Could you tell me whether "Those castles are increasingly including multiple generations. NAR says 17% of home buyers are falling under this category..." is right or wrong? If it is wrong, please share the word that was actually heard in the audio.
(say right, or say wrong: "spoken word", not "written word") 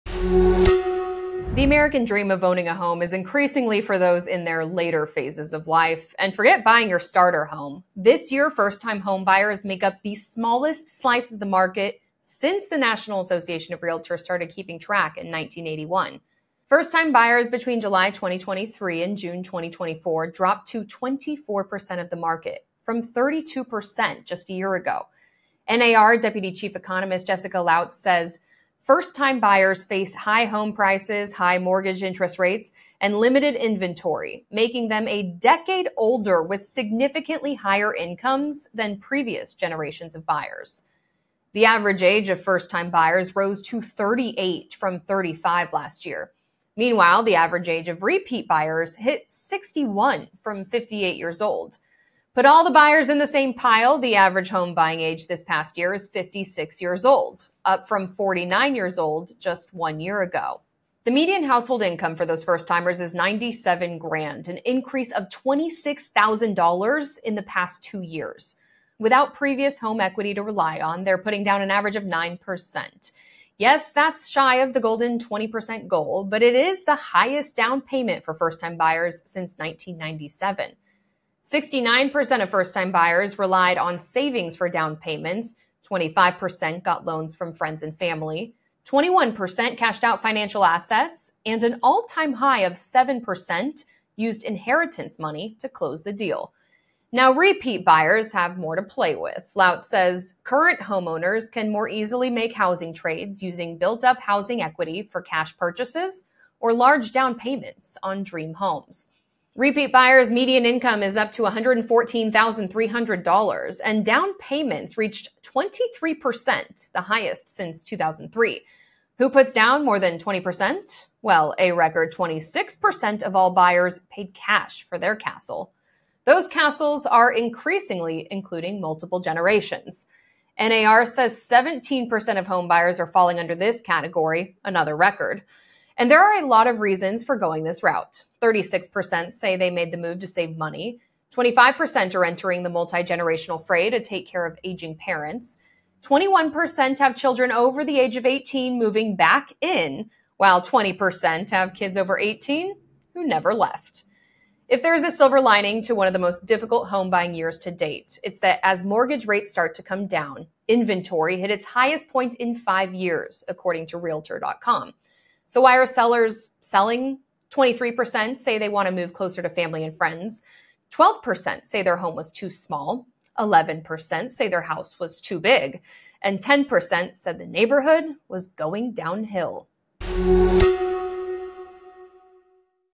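right.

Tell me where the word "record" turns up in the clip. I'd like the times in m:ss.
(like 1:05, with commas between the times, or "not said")
2:01, 2:14.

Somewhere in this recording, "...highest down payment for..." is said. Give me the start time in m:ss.
1:16.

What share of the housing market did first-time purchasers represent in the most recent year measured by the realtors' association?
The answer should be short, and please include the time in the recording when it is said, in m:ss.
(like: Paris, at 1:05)
24%, at 0:20.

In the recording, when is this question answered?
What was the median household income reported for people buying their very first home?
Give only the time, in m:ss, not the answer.
1:03.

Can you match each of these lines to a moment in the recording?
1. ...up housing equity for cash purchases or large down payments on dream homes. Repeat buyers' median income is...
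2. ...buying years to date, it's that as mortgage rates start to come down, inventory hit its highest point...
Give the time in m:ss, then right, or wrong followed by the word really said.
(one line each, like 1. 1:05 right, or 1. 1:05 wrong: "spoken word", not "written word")
1. 1:44 right
2. 2:37 right.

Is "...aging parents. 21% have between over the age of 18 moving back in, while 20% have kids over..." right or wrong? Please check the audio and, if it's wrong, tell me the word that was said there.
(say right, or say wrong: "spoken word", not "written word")
wrong: "children", not "between".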